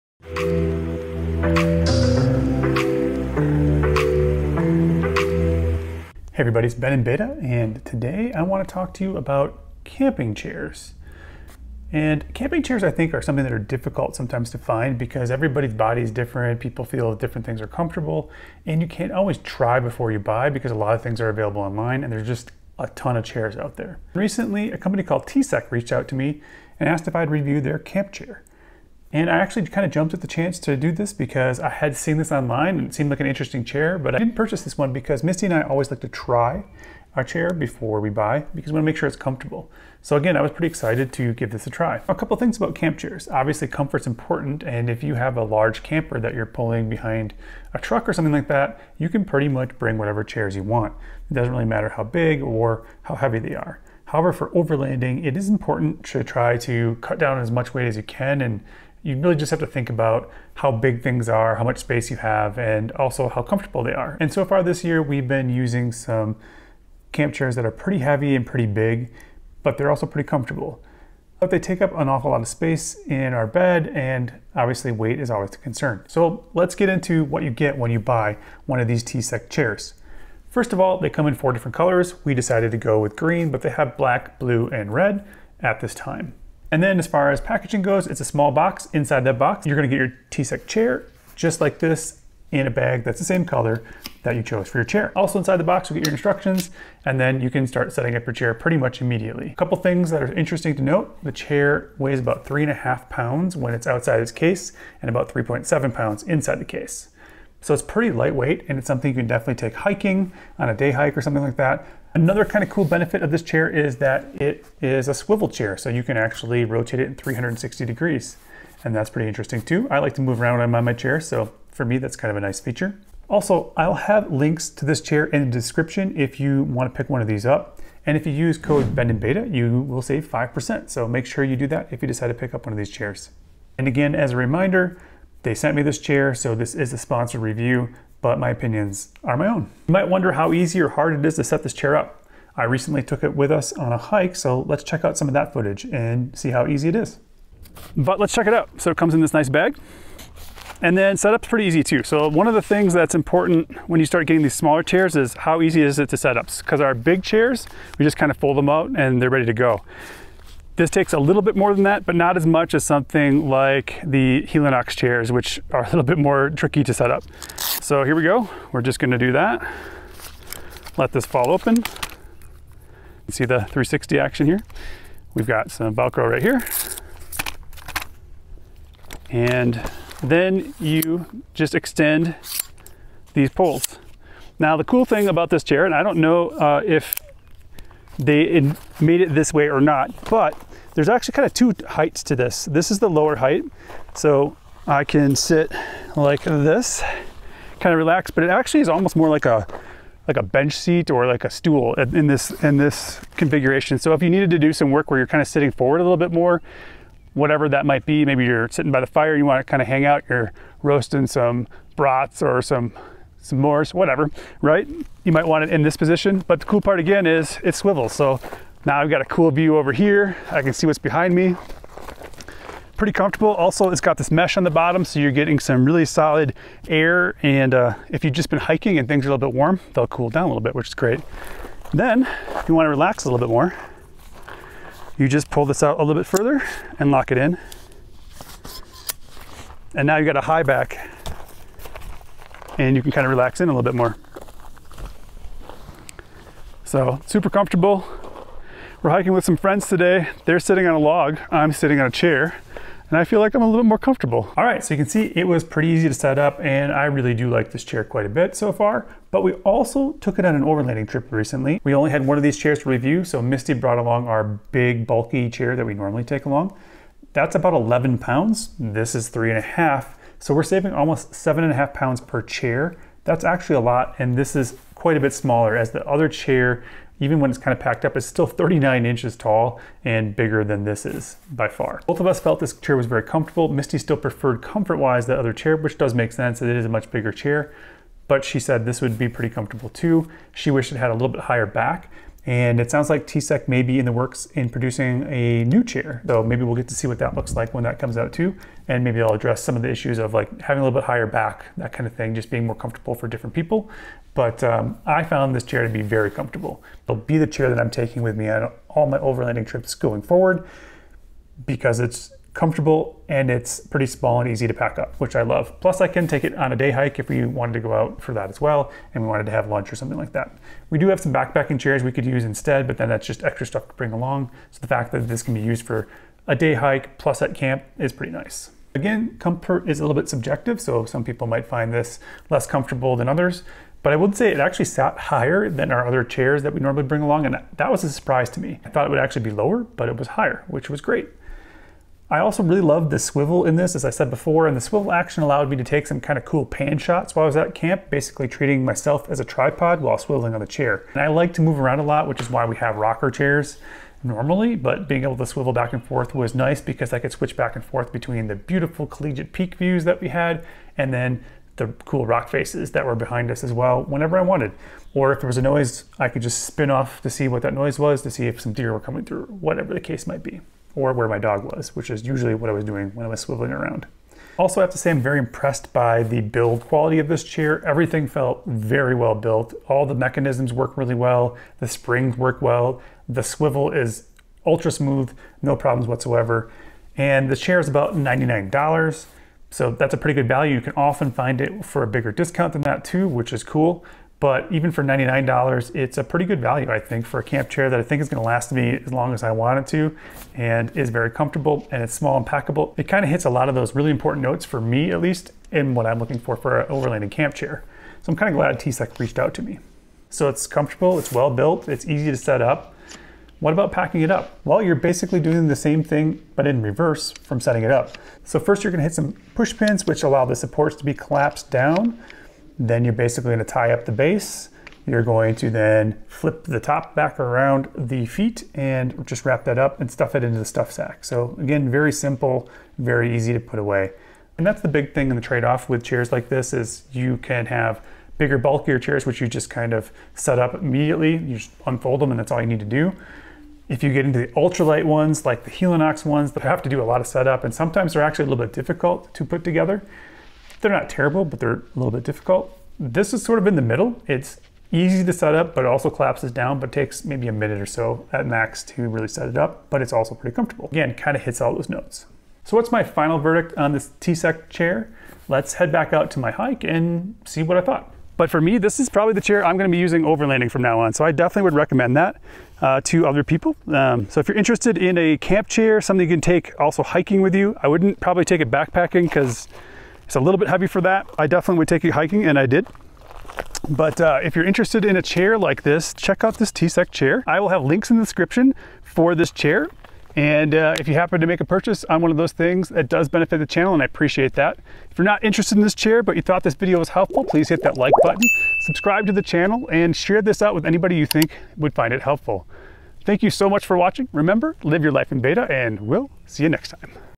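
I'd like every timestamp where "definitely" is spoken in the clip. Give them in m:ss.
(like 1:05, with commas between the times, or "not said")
1:49, 7:51, 8:01.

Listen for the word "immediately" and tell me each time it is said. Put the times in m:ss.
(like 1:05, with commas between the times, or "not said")
1:39, 7:20.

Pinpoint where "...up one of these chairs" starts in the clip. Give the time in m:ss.
2:12.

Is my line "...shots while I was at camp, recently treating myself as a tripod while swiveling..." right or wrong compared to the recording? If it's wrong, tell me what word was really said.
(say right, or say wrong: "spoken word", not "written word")
wrong: "basically", not "recently".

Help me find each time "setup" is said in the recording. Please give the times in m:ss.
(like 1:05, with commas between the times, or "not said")
2:31, 7:27.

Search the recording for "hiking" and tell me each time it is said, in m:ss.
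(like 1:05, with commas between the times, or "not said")
1:49, 3:48, 4:09, 7:57, 8:02.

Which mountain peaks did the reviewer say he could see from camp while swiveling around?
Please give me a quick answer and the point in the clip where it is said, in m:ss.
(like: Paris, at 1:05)
Collegiate peak, at 5:59.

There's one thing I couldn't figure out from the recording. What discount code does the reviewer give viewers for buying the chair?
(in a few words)
BENINBETA.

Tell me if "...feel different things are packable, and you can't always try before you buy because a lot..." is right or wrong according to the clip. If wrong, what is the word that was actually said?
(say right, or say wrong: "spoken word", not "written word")
wrong: "comfortable", not "packable".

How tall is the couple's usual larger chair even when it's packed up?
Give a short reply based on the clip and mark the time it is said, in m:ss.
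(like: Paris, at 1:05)
39 inches, at 4:38.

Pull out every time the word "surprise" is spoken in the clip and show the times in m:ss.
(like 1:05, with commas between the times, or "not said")
5:38.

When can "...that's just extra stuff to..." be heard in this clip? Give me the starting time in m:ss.
5:23.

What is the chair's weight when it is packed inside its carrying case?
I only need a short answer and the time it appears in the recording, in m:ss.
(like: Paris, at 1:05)
3.7 pounds, at 1:45.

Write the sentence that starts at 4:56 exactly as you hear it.
So maybe we'll get to see what that looks like when that comes out too.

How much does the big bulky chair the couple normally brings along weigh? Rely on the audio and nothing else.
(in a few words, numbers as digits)
11 pounds.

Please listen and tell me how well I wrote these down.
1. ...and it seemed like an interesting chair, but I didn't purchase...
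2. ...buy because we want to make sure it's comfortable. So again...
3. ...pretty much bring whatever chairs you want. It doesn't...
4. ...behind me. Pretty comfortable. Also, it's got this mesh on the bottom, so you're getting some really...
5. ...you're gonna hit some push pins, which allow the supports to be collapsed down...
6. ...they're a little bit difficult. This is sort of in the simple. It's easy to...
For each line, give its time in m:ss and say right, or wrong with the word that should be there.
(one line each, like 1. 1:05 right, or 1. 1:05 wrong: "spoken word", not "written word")
1. 0:32 right
2. 0:38 right
3. 0:49 right
4. 3:40 right
5. 6:58 right
6. 7:31 wrong: "middle", not "simple".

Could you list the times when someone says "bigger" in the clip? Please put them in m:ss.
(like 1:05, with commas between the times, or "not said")
4:40, 4:47, 6:32, 7:18.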